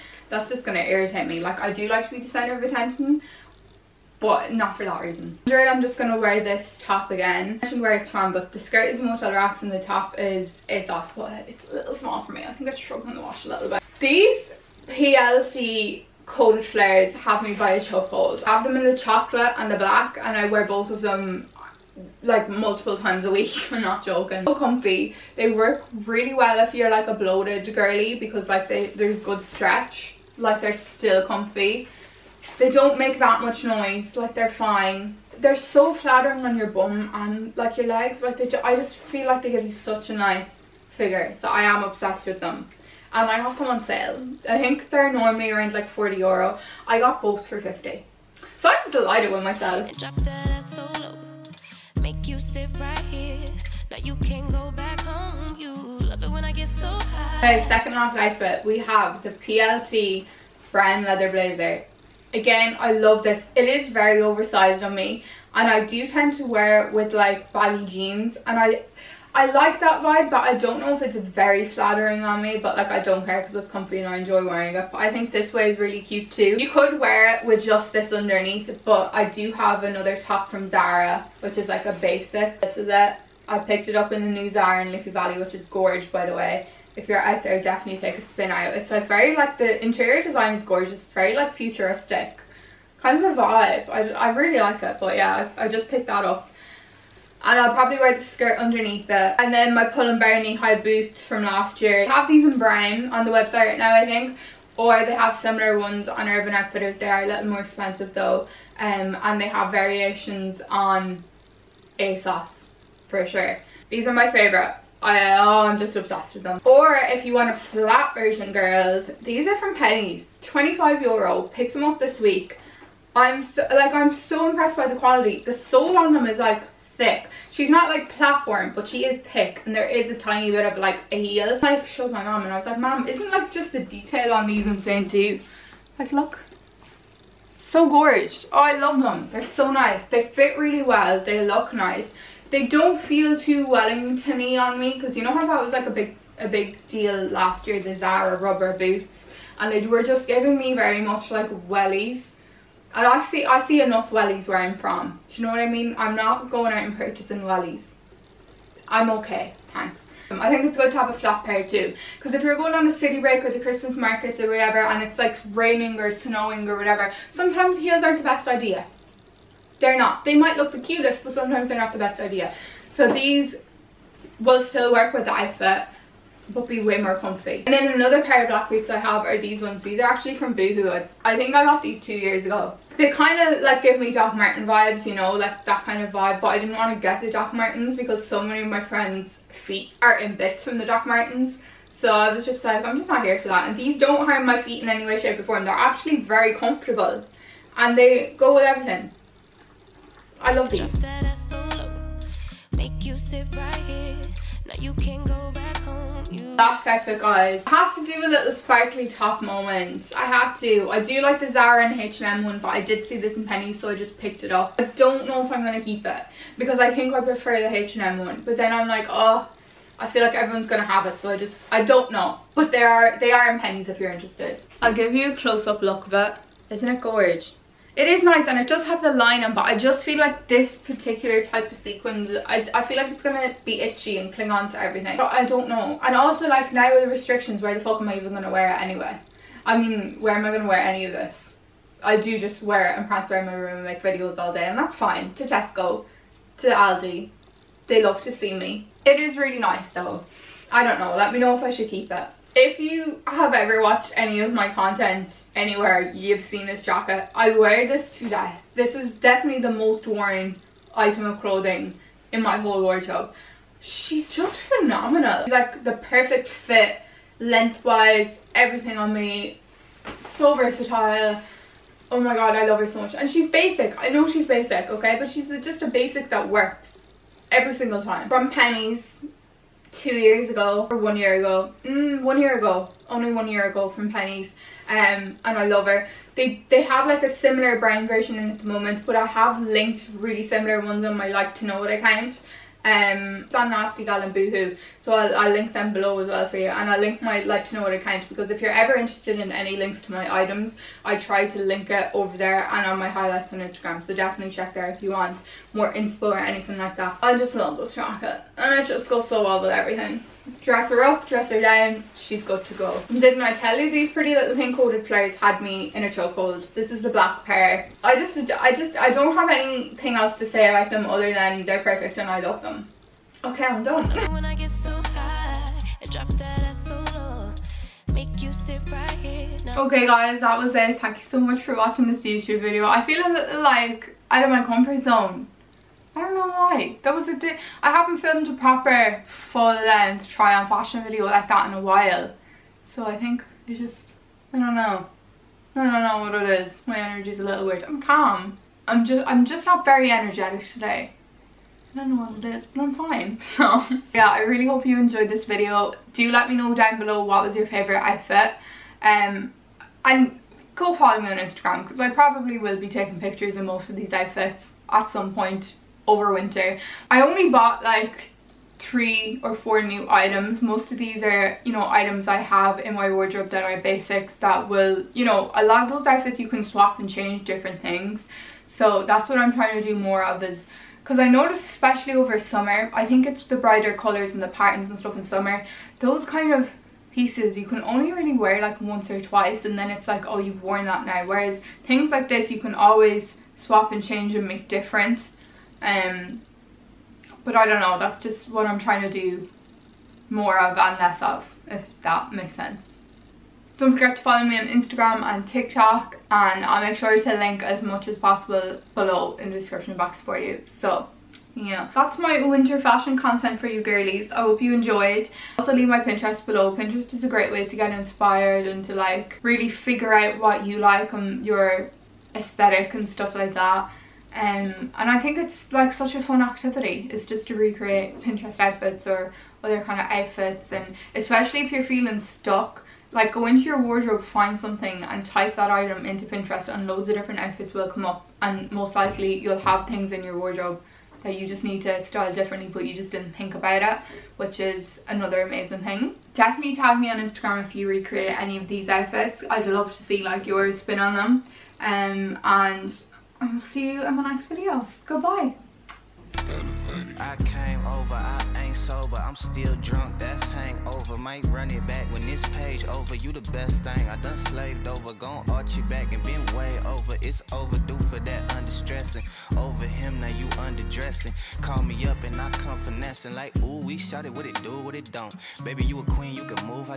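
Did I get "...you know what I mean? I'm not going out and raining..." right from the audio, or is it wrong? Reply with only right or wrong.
wrong.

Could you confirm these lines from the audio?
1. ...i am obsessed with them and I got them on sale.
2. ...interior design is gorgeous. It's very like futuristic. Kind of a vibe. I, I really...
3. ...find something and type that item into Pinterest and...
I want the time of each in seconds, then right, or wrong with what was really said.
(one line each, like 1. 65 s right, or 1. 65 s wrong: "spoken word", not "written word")
1. 41 s right
2. 89 s right
3. 434 s right.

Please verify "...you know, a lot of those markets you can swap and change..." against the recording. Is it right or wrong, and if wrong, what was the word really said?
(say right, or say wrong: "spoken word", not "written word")
wrong: "outfits", not "markets".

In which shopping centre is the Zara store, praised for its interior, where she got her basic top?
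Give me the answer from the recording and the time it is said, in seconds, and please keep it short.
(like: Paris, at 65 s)
Liffey Valley, at 84 s.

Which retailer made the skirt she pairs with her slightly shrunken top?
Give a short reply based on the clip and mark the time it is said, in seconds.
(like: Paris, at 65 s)
Motel Rocks, at 9 s.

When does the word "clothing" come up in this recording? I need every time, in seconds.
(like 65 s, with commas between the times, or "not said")
261 s.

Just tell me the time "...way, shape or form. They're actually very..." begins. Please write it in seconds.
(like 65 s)
195 s.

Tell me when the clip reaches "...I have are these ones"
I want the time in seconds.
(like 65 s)
178 s.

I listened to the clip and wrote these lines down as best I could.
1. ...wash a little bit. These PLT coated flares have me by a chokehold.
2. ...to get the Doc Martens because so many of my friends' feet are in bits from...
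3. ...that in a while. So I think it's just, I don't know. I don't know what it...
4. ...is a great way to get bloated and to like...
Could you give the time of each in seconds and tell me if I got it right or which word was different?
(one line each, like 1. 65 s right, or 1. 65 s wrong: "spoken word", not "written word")
1. 13 s right
2. 186 s right
3. 341 s right
4. 417 s wrong: "inspired", not "bloated".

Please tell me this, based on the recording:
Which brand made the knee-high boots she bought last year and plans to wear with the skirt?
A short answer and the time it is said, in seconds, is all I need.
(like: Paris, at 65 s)
Pull and Bear, at 99 s.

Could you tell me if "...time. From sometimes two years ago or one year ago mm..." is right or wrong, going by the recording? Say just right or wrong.
wrong.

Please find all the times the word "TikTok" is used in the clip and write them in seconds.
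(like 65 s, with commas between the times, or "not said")
405 s.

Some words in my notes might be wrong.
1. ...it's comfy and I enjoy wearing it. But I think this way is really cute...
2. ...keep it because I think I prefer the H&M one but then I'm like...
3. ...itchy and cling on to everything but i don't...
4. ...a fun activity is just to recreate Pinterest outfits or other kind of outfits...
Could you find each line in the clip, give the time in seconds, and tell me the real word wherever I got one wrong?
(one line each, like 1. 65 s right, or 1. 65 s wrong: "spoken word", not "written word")
1. 73 s right
2. 215 s right
3. 233 s right
4. 426 s right.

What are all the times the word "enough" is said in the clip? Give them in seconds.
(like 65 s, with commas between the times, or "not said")
153 s.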